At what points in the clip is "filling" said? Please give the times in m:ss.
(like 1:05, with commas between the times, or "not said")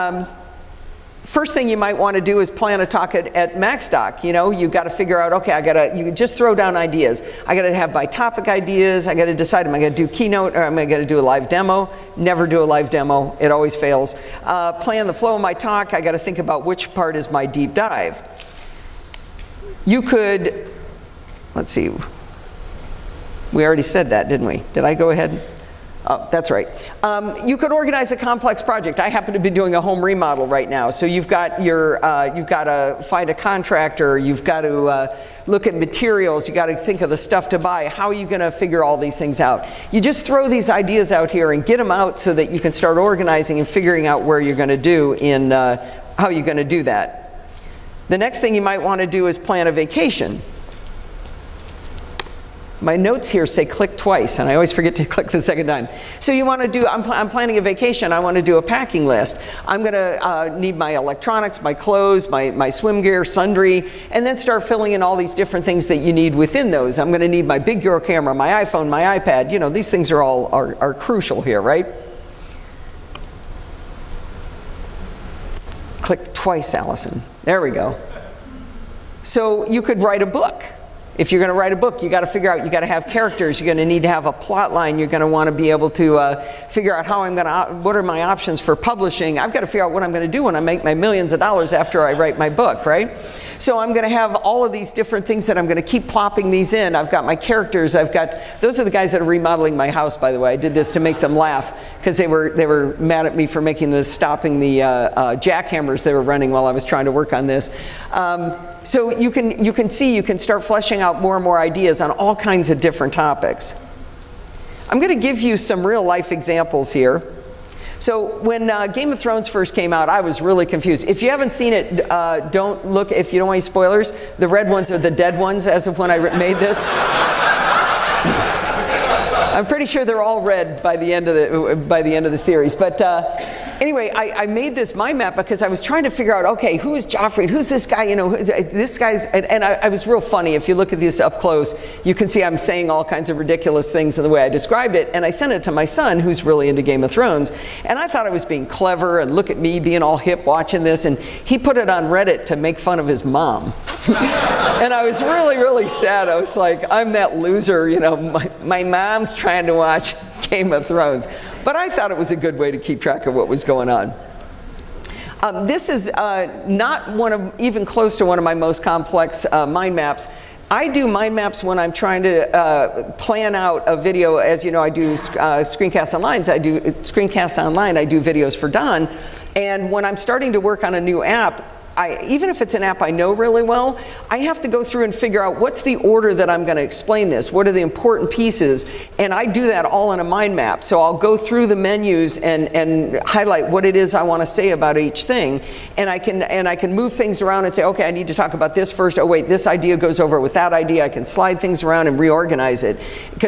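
1:04.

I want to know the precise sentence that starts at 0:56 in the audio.
So you want to do, I'm, pl I'm, planning a vacation, I want to do a packing list.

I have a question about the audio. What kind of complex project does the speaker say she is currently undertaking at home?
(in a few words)
home remodel.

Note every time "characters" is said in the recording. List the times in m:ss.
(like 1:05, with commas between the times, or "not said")
1:23, 1:37.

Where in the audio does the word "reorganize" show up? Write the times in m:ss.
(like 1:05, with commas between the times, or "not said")
3:22.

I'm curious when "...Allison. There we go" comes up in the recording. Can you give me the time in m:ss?
1:16.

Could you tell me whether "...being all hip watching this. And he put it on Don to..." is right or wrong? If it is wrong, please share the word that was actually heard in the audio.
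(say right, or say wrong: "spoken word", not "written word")
wrong: "Reddit", not "Don".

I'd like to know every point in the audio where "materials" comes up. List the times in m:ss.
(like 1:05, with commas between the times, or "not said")
0:35.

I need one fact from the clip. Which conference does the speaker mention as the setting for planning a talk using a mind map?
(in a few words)
MacStock.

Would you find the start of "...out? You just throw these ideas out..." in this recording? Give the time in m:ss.
0:39.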